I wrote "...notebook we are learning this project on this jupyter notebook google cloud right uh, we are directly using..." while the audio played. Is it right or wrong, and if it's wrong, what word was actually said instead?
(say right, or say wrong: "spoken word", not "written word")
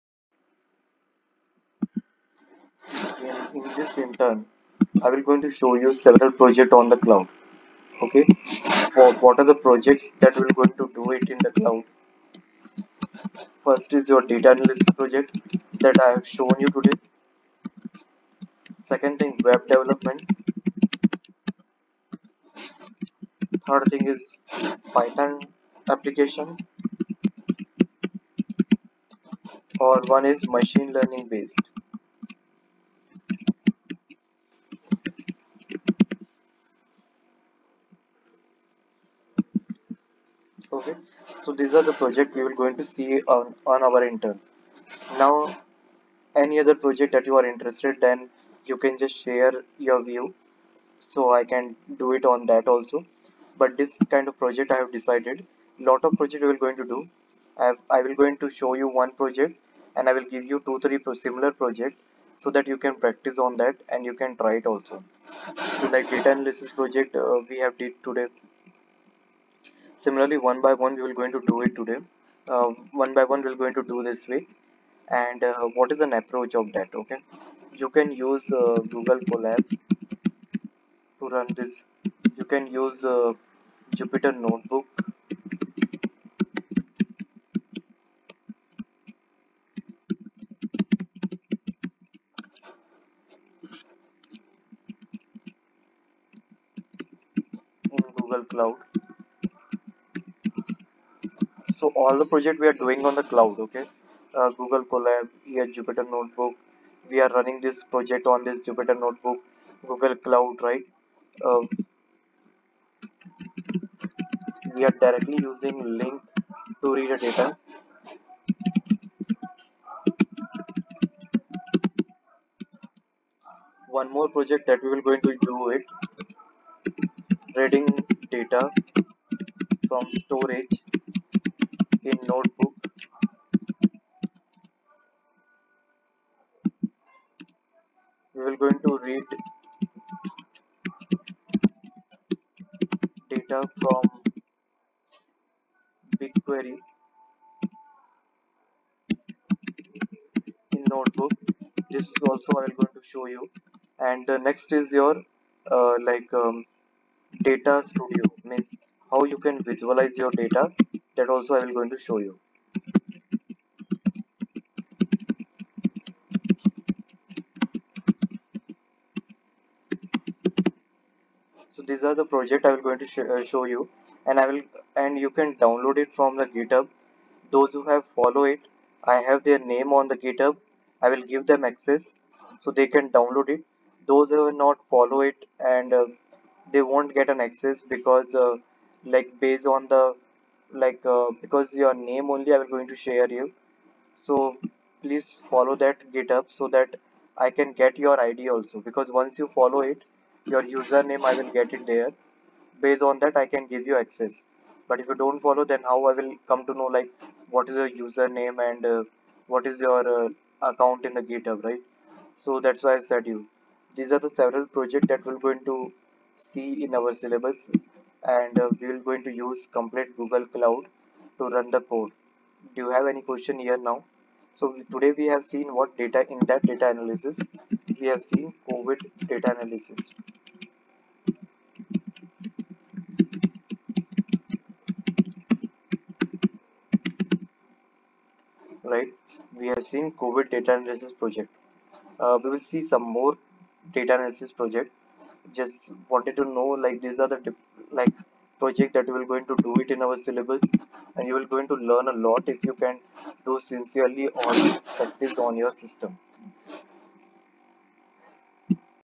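wrong: "running", not "learning".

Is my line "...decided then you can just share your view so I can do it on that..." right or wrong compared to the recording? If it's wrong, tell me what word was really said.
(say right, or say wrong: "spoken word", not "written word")
wrong: "interested", not "decided".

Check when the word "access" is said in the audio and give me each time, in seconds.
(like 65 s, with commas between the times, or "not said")
181 s, 187 s, 203 s.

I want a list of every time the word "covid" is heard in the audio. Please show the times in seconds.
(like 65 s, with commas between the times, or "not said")
228 s, 240 s.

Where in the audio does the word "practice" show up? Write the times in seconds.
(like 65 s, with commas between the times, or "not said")
62 s, 255 s.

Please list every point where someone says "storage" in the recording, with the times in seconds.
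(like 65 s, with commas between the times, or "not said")
130 s.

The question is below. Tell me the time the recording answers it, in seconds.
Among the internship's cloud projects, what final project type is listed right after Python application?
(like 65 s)
30 s.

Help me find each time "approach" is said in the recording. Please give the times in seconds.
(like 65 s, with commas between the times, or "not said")
76 s.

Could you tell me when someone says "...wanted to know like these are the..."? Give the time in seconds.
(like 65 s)
246 s.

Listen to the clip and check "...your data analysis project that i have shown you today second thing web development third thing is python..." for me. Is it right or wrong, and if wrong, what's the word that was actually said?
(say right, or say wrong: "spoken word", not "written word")
right.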